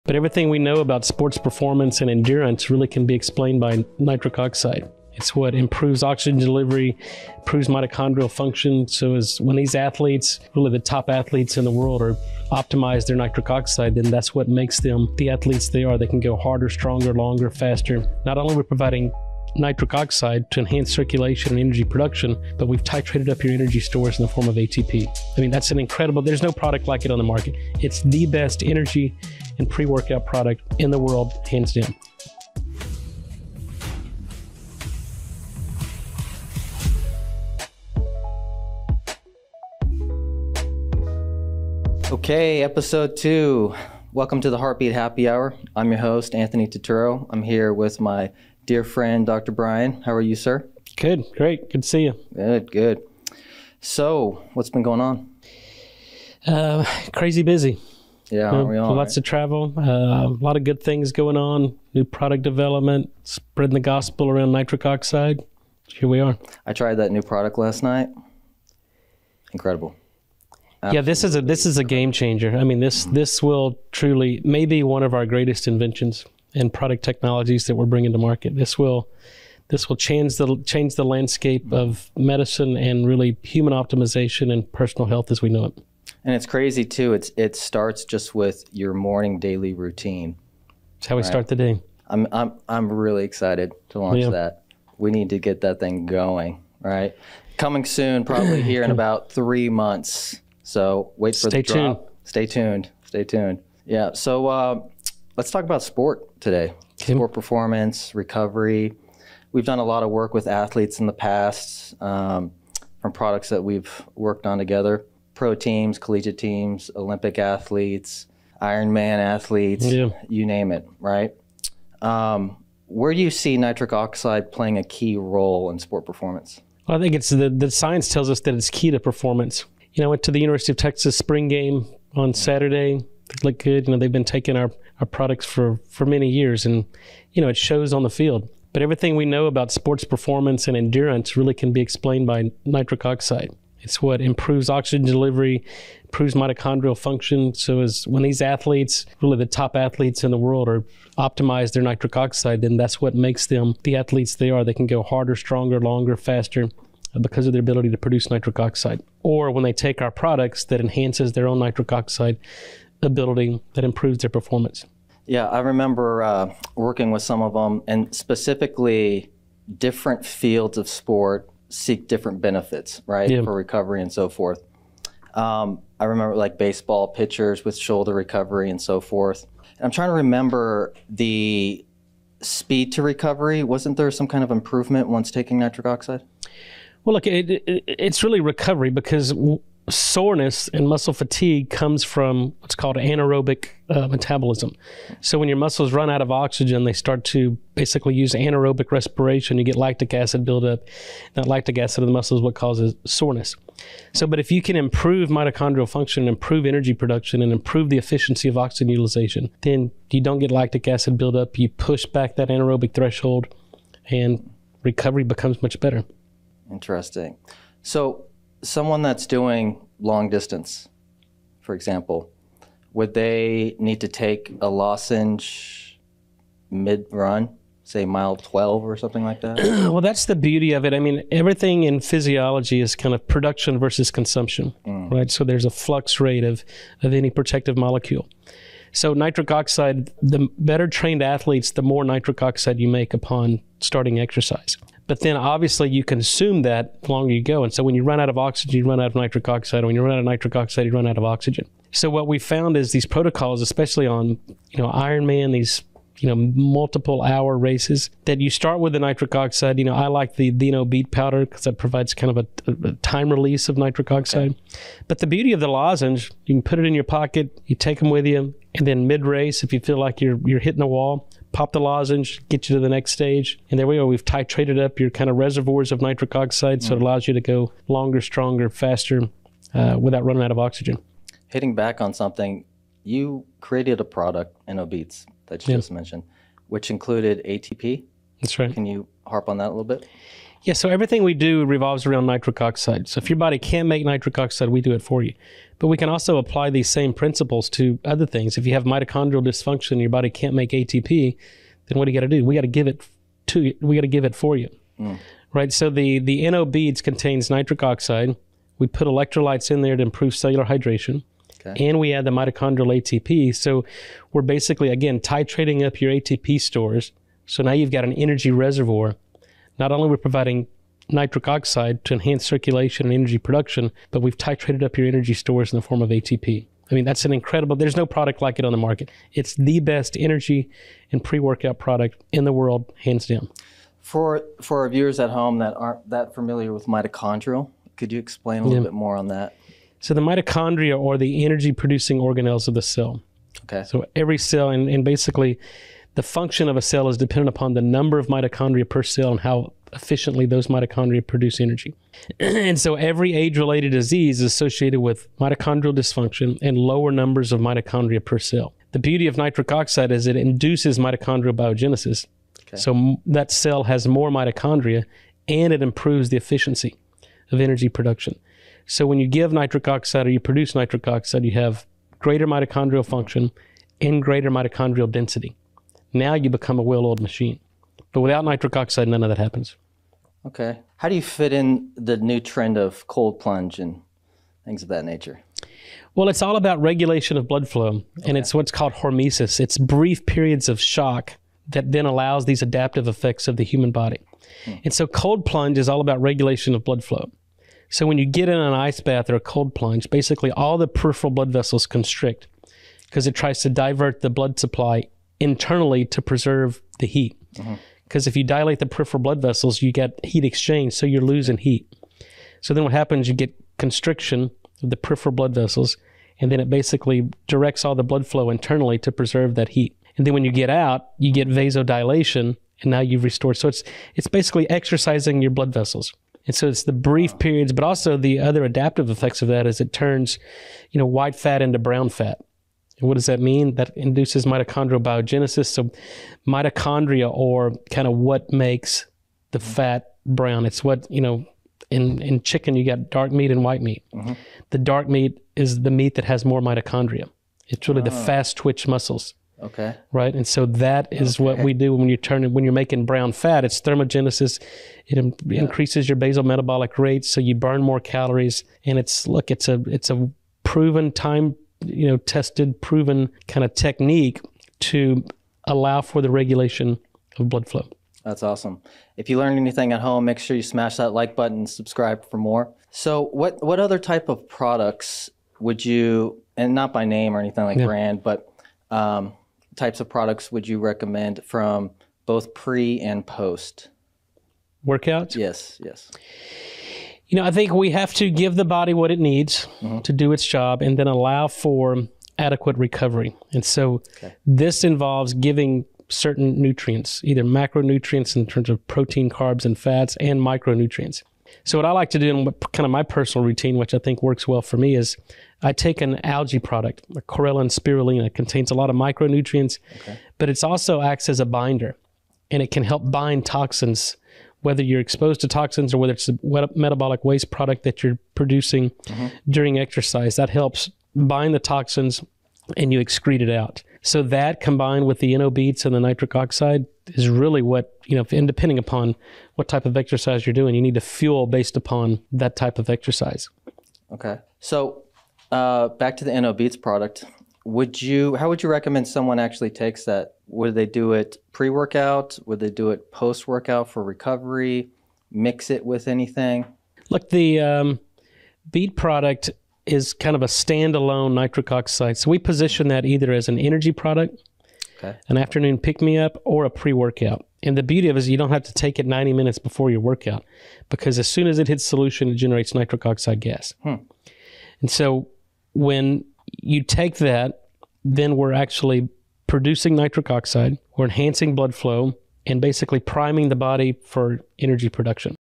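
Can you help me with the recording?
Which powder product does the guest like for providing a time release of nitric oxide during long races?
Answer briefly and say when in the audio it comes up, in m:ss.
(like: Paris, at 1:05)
Dino beet powder, at 4:20.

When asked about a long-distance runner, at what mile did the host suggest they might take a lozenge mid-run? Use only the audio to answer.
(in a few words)
12.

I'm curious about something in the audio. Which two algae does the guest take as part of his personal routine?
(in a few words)
Chlorella and spirulina.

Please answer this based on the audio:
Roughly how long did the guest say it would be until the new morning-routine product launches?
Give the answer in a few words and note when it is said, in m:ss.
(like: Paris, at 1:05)
3 months, at 1:39.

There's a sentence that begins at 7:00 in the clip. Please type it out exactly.
And then when you get out, you get vasodilation, and now you've restored.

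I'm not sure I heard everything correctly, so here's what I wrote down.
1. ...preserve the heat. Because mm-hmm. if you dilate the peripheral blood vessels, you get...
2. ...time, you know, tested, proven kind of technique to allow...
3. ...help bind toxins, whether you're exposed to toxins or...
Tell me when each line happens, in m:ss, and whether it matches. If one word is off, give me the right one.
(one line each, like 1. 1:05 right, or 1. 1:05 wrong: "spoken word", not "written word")
1. 6:46 right
2. 7:41 right
3. 8:32 right.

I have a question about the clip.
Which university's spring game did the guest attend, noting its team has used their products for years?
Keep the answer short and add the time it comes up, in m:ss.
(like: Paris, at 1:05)
University of Texas, at 2:10.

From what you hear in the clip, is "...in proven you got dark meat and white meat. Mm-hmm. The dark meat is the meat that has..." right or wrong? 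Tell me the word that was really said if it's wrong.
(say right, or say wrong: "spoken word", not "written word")
wrong: "chicken", not "proven".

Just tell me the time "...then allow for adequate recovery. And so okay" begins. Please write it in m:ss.
8:10.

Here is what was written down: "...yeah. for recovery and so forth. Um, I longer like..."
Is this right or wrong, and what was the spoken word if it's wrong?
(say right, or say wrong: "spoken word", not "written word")
wrong: "remember", not "longer".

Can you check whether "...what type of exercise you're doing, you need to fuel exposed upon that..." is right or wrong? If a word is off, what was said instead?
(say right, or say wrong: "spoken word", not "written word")
wrong: "based", not "exposed".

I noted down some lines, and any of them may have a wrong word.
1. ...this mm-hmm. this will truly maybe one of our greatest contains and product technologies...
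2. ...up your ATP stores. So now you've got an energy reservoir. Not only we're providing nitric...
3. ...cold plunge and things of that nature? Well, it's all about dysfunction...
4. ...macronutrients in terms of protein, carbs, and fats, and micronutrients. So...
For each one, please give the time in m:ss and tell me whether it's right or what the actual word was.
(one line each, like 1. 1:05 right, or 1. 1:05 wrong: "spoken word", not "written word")
1. 1:12 wrong: "inventions", not "contains"
2. 5:15 right
3. 6:23 wrong: "regulation", not "dysfunction"
4. 8:17 right.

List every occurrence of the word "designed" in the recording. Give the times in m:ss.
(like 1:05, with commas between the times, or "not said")
not said.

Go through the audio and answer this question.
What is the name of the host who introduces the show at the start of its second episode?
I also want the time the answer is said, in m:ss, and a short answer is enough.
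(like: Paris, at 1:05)
Anthony Totoro, at 0:46.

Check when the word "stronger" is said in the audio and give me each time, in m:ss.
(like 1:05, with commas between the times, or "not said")
0:16, 2:35, 4:38.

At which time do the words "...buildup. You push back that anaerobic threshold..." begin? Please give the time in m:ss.
3:31.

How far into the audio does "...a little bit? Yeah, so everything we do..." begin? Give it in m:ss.
4:49.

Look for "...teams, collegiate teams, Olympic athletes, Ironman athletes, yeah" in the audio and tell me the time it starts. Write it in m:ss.
1:55.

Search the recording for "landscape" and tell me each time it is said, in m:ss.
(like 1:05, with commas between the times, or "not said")
1:21.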